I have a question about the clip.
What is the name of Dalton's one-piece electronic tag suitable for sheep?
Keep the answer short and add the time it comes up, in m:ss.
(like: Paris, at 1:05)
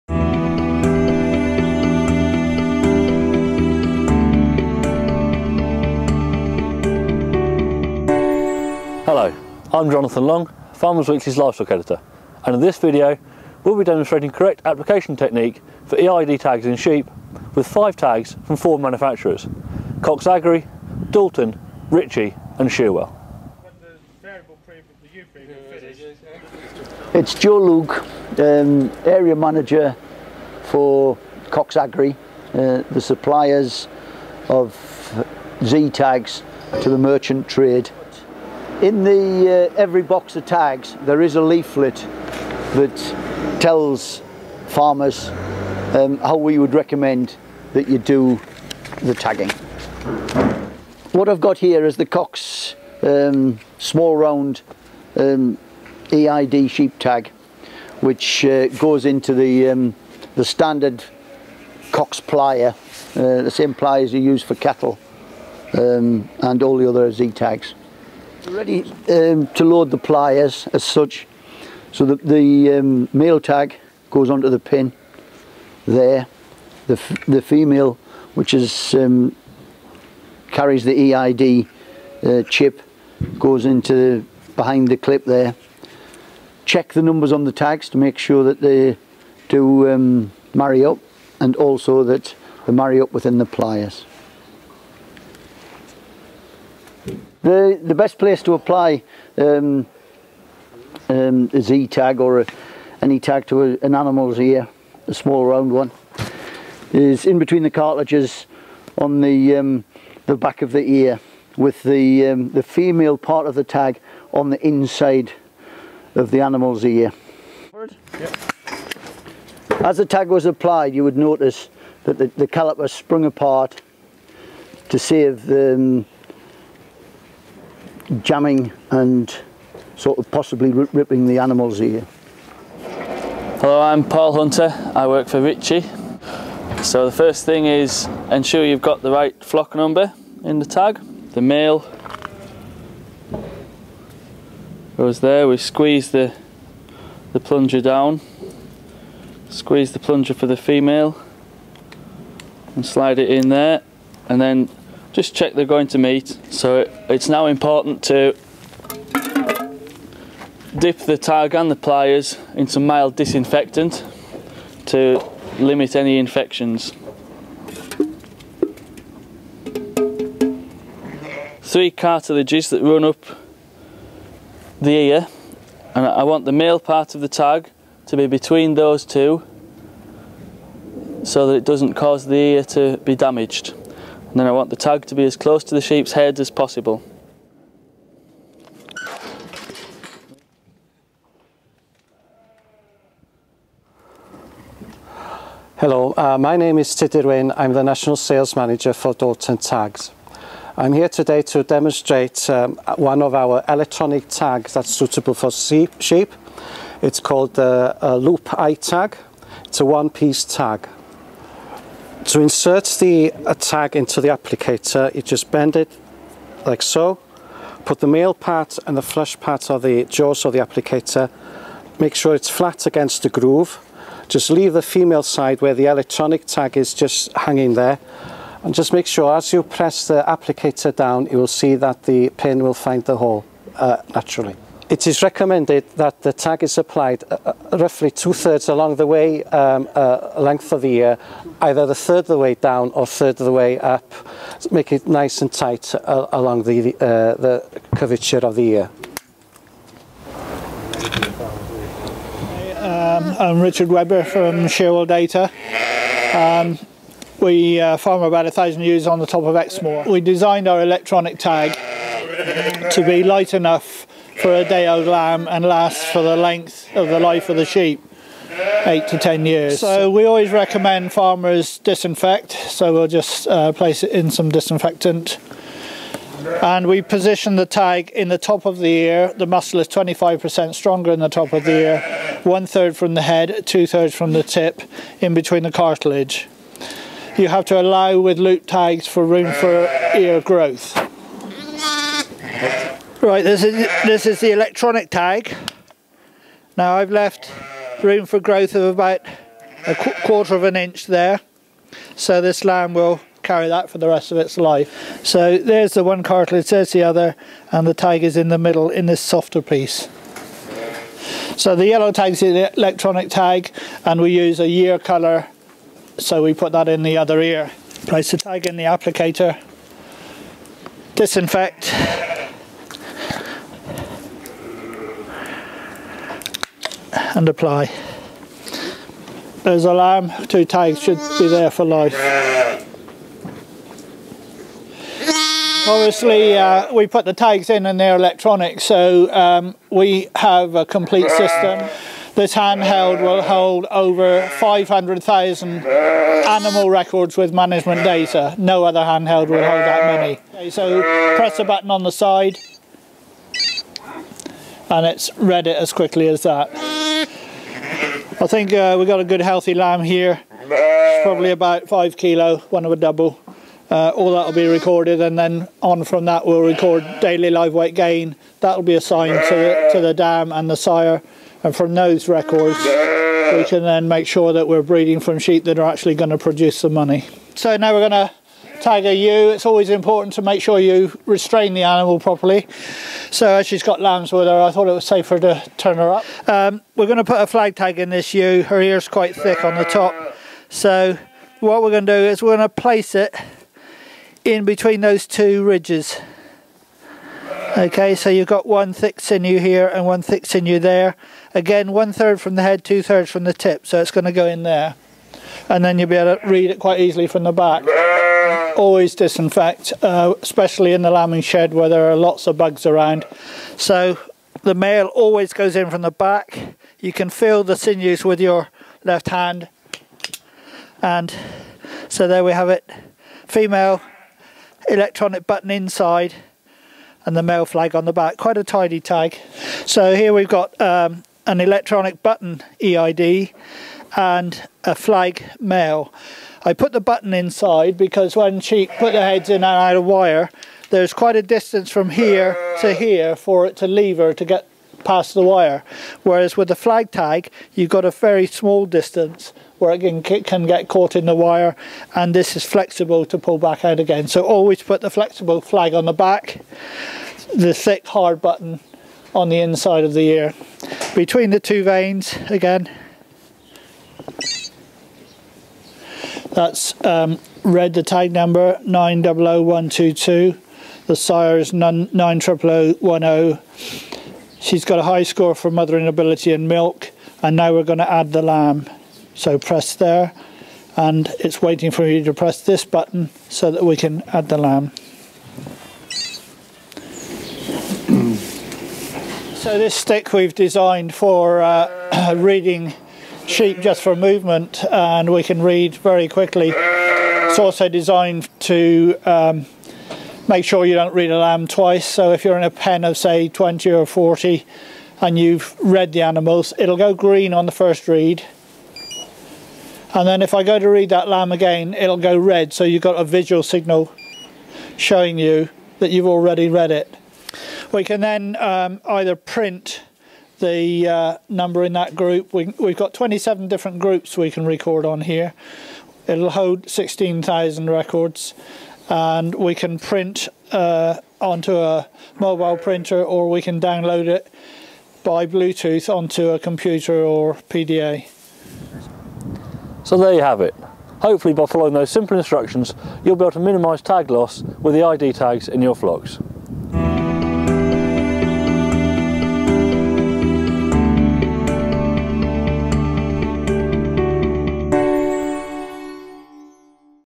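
Loop Eye Tag, at 3:28.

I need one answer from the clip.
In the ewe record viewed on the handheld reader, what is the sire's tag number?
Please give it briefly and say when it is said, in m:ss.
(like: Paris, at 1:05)
900010, at 7:51.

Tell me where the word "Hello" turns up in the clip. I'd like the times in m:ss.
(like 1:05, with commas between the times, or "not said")
2:13, 3:15.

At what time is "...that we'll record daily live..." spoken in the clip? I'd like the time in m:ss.
6:06.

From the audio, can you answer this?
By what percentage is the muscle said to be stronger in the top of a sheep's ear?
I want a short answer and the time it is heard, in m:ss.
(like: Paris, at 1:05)
25%, at 4:39.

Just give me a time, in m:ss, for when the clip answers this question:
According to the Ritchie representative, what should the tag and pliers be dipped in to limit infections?
2:42.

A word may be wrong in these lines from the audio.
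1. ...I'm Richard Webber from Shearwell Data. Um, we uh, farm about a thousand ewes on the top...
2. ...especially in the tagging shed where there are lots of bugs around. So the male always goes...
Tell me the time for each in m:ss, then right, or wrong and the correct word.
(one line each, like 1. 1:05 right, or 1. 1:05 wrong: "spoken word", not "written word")
1. 4:13 right
2. 6:50 wrong: "lambing", not "tagging".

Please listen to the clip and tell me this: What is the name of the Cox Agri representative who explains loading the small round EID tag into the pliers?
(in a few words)
Joe Luke.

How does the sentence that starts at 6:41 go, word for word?
Again, one third from the head, two thirds from the tip, so it's going to go in there.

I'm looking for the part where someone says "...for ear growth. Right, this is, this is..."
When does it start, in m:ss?
4:49.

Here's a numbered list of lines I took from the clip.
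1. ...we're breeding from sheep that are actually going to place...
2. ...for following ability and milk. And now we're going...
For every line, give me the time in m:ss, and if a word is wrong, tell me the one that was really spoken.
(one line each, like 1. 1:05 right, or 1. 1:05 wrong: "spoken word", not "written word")
1. 6:14 wrong: "produce", not "place"
2. 7:55 wrong: "mothering", not "following".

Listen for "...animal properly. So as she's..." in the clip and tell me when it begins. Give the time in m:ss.
6:21.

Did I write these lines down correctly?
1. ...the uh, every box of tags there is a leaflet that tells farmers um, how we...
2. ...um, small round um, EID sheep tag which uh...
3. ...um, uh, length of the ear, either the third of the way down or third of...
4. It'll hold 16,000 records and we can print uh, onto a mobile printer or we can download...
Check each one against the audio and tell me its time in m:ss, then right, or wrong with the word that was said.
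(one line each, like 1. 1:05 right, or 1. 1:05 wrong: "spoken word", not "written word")
1. 0:39 right
2. 0:53 right
3. 3:59 right
4. 8:46 right.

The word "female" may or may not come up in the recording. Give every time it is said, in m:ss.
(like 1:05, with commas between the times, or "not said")
1:17, 1:52, 2:30, 3:44, 7:03.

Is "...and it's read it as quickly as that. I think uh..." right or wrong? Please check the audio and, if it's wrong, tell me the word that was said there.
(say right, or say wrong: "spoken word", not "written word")
right.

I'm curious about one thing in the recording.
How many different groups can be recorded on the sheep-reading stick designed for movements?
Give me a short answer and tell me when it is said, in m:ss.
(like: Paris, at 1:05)
27, at 8:43.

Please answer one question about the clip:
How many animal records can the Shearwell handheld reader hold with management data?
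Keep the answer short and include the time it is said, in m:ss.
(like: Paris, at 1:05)
500,000, at 5:44.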